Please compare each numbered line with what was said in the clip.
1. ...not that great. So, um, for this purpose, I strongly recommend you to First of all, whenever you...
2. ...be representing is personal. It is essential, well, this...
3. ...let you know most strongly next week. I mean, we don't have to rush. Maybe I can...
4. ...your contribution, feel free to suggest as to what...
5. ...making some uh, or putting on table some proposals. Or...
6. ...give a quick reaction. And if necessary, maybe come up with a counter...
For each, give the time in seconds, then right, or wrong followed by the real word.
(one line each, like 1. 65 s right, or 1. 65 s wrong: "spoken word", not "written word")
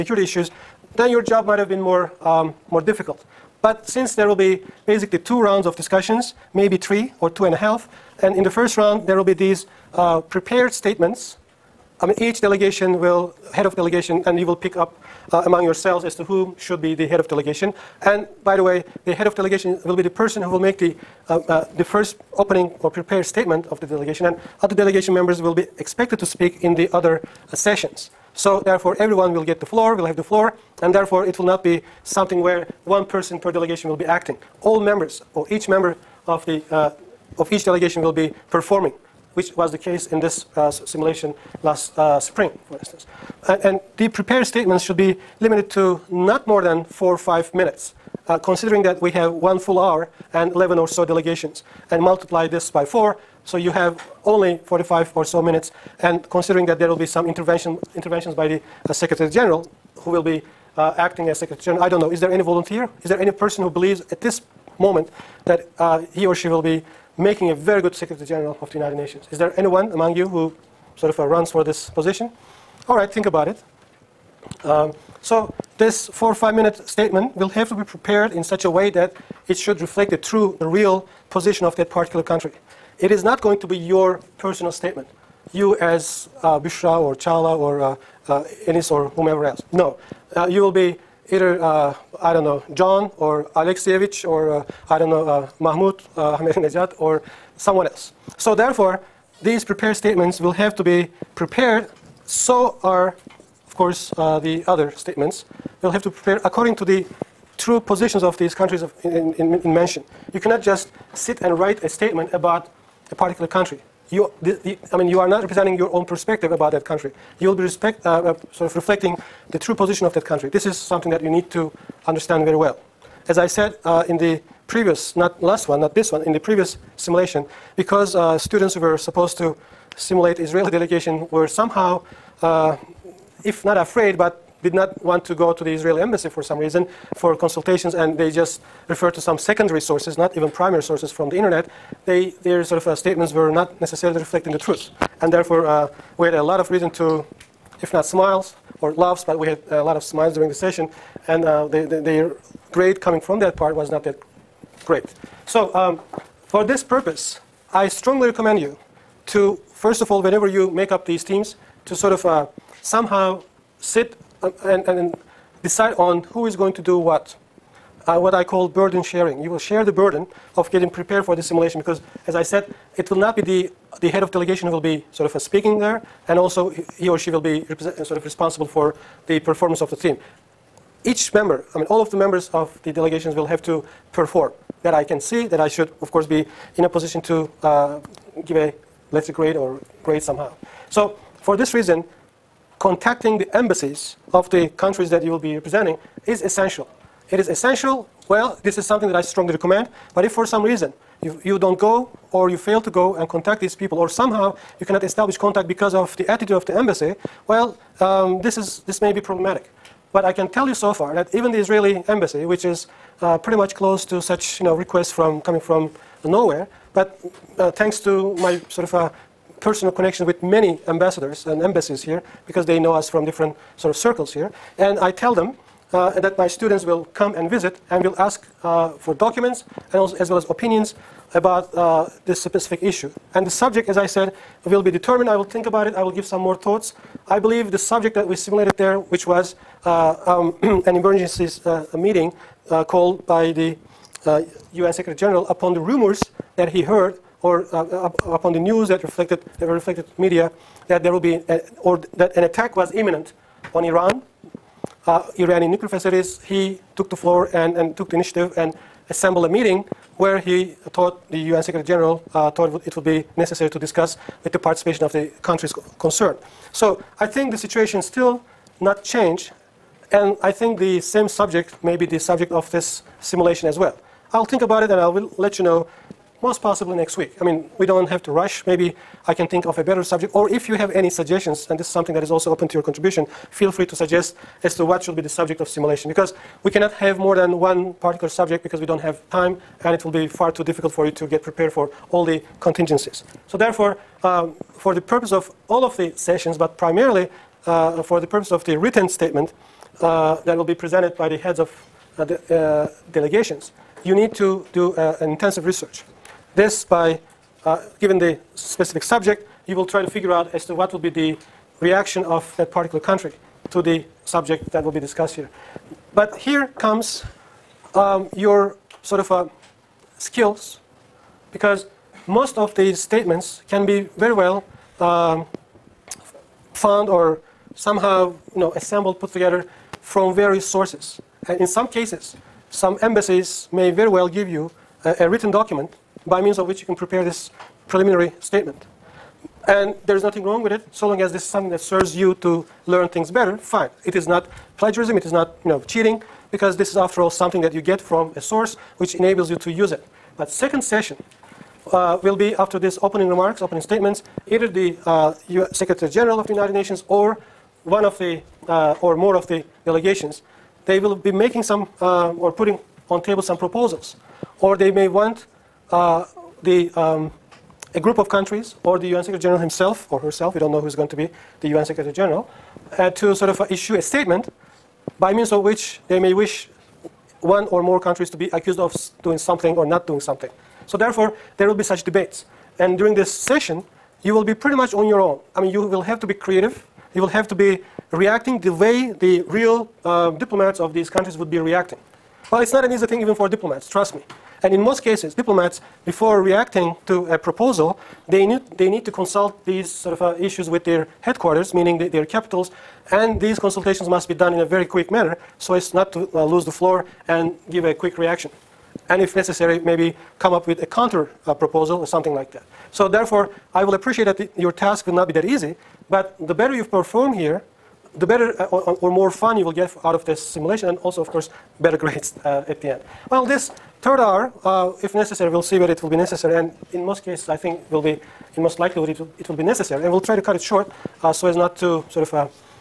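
1. 153 s right
2. 195 s wrong: "essential", not "personal"
3. 275 s wrong: "possibly", not "strongly"
4. 282 s right
5. 361 s right
6. 407 s right.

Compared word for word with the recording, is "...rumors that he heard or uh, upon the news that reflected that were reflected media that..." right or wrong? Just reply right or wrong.
right.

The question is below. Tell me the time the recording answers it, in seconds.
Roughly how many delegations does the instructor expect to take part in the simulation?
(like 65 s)
50 s.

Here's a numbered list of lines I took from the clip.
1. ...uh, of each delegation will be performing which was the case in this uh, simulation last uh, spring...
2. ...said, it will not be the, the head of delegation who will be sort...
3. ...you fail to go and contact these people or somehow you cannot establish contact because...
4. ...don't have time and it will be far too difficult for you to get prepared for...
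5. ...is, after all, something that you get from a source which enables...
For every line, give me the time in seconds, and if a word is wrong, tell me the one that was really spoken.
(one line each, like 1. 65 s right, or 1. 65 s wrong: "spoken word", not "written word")
1. 36 s right
2. 172 s right
3. 202 s right
4. 288 s right
5. 346 s right.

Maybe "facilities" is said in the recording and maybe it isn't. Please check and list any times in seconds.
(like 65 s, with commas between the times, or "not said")
255 s.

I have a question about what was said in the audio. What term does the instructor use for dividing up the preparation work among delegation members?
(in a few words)
Burden sharing.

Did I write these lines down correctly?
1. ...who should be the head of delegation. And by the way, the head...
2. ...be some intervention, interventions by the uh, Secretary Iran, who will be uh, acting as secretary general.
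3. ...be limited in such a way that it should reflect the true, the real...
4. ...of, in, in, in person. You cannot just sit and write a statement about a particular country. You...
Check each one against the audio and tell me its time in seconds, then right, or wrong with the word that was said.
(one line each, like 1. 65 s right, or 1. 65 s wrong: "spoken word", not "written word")
1. 16 s right
2. 56 s wrong: "General", not "Iran"
3. 77 s wrong: "prepared", not "limited"
4. 108 s wrong: "mention", not "person".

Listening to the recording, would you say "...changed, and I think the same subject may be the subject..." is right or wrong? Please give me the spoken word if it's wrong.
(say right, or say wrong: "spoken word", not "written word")
right.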